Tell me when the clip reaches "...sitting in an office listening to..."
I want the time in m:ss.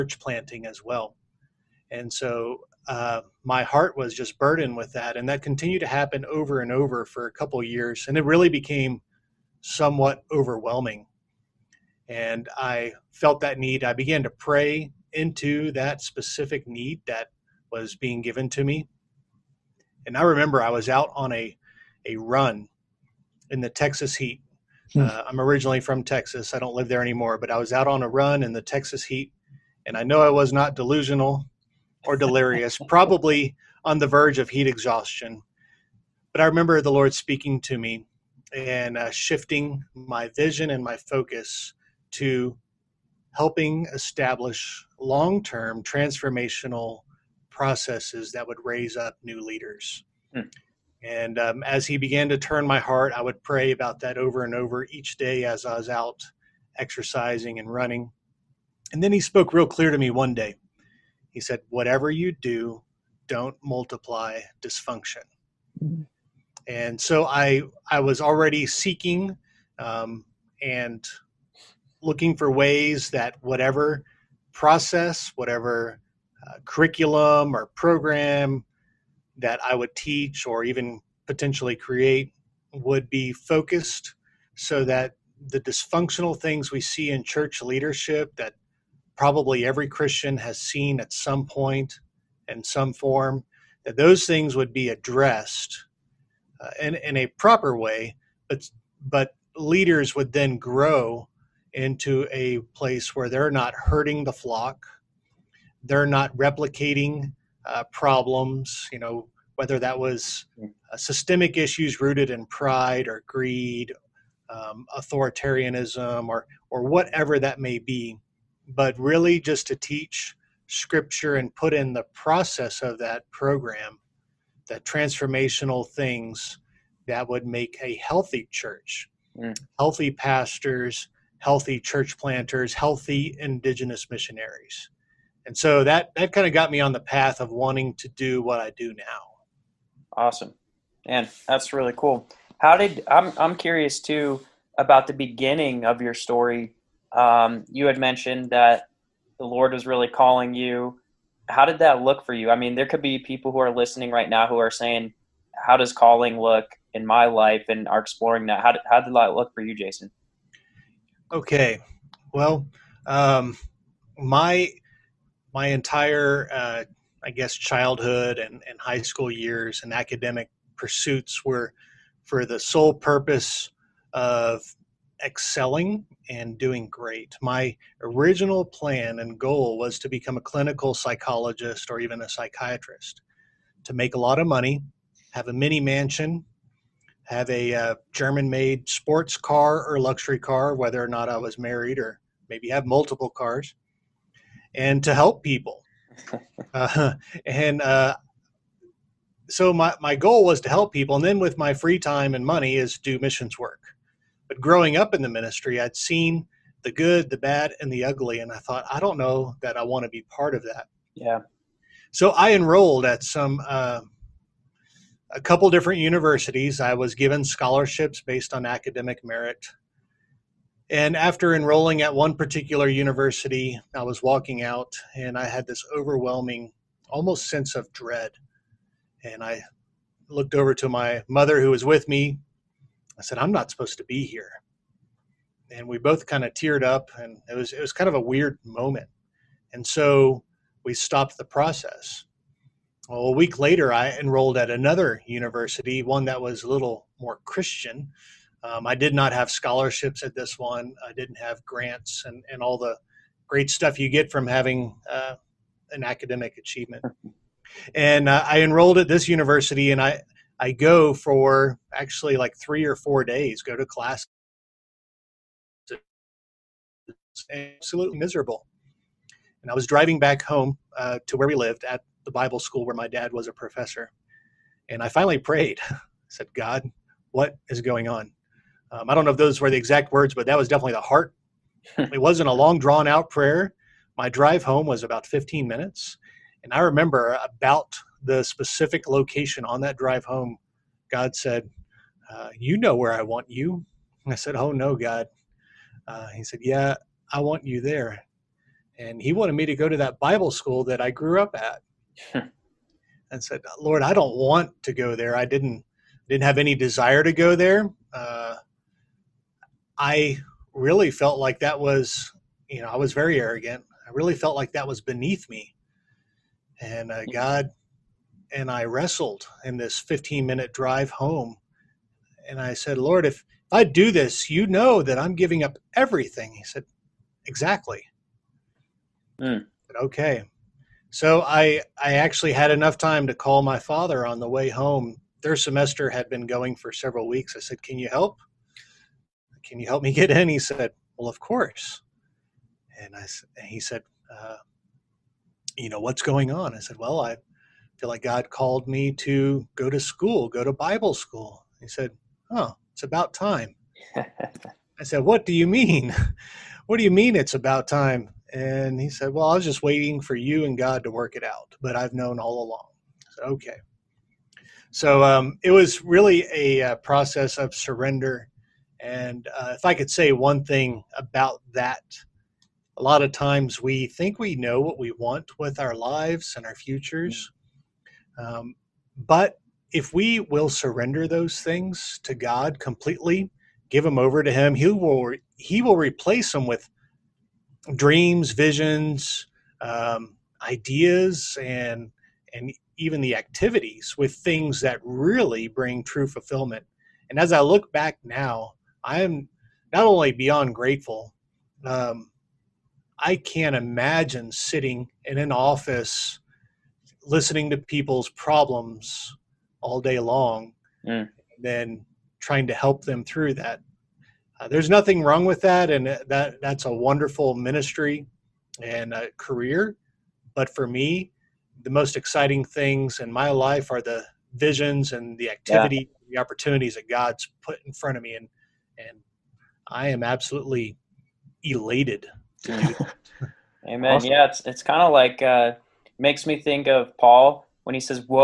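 6:44.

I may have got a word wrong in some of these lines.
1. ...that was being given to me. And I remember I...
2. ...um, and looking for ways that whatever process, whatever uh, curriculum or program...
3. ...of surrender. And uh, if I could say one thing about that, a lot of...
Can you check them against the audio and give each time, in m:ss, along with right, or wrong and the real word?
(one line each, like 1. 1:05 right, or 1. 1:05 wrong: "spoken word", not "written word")
1. 0:17 right
2. 1:09 right
3. 6:07 right.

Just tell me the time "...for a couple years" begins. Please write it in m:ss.
0:07.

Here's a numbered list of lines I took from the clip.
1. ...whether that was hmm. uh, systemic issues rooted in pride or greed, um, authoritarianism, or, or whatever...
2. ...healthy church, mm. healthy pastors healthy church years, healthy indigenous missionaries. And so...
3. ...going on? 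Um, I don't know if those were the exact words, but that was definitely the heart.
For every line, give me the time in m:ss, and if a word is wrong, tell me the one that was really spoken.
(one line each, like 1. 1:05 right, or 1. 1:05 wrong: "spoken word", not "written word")
1. 1:49 right
2. 2:07 wrong: "planters", not "years"
3. 4:37 right.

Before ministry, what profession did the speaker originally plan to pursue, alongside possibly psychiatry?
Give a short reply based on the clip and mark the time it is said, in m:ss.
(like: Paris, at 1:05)
clinical psychologist, at 3:00.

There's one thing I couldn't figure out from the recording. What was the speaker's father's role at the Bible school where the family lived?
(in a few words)
professor.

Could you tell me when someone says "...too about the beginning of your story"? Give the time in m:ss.
2:24.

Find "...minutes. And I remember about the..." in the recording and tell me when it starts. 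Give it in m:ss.
4:45.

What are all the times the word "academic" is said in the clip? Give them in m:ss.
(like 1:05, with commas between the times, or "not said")
2:49, 3:38, 4:16.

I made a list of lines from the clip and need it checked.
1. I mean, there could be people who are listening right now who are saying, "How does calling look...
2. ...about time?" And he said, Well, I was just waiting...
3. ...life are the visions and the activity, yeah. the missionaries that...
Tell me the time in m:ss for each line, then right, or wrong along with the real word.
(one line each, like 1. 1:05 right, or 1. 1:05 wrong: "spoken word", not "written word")
1. 2:32 right
2. 5:57 right
3. 7:03 wrong: "opportunities", not "missionaries".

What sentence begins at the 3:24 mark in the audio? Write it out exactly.
But growing up in the ministry, I'd seen the good, the bad, and the ugly.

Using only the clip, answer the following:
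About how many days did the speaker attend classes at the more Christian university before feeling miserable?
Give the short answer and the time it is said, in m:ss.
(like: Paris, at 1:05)
three or four days, at 4:22.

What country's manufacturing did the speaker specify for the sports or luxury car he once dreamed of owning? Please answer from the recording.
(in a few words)
German.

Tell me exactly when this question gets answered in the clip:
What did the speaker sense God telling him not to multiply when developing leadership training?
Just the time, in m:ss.
1:04.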